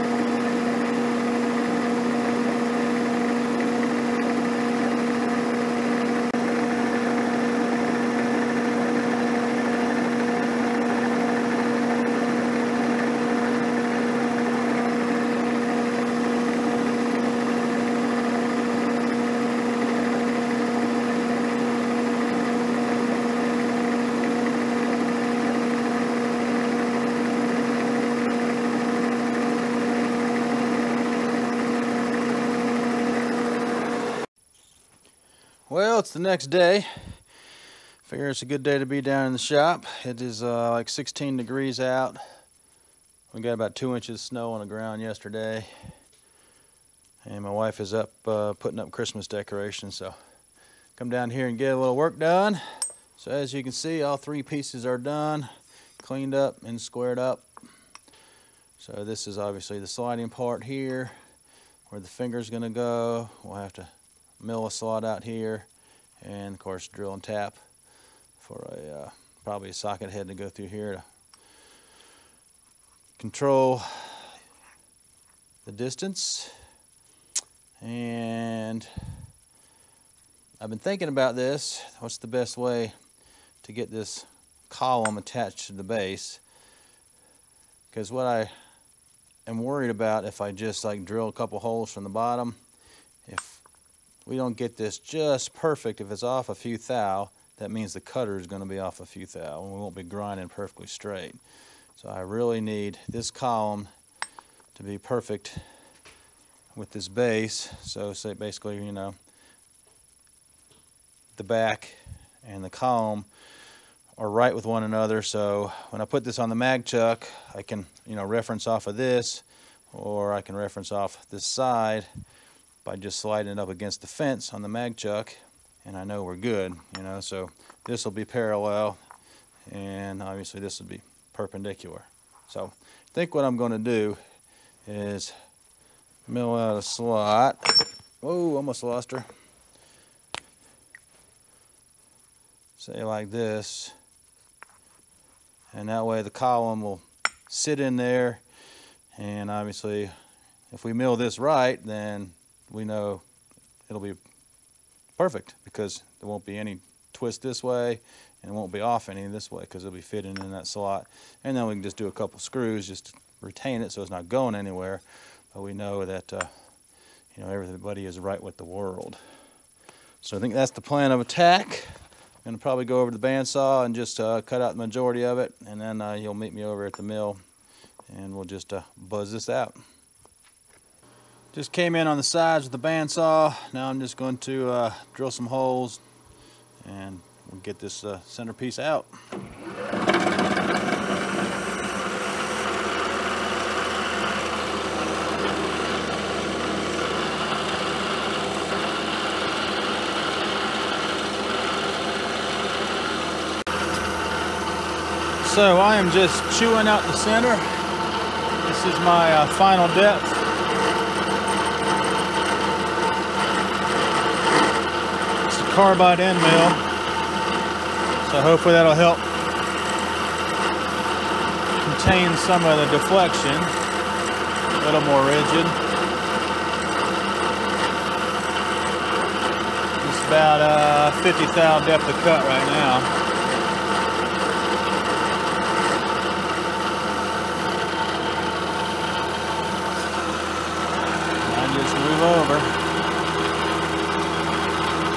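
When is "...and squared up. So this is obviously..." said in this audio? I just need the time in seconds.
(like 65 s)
56 s.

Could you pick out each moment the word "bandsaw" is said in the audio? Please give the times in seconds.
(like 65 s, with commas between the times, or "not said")
173 s, 182 s.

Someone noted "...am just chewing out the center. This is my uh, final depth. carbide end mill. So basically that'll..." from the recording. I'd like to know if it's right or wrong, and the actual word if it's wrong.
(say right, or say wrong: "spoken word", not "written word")
wrong: "hopefully", not "basically".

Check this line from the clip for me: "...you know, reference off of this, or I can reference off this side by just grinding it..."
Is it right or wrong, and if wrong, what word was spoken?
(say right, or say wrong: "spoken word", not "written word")
wrong: "sliding", not "grinding".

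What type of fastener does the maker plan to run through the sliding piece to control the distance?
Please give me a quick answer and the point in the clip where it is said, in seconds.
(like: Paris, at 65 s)
socket head, at 69 s.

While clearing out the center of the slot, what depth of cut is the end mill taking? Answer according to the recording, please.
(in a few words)
50 thou.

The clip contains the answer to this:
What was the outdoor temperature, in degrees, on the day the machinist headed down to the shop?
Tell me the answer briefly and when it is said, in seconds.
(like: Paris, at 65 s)
16, at 40 s.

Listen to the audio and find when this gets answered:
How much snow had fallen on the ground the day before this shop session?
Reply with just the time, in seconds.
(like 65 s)
43 s.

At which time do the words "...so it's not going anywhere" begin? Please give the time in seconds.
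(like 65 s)
163 s.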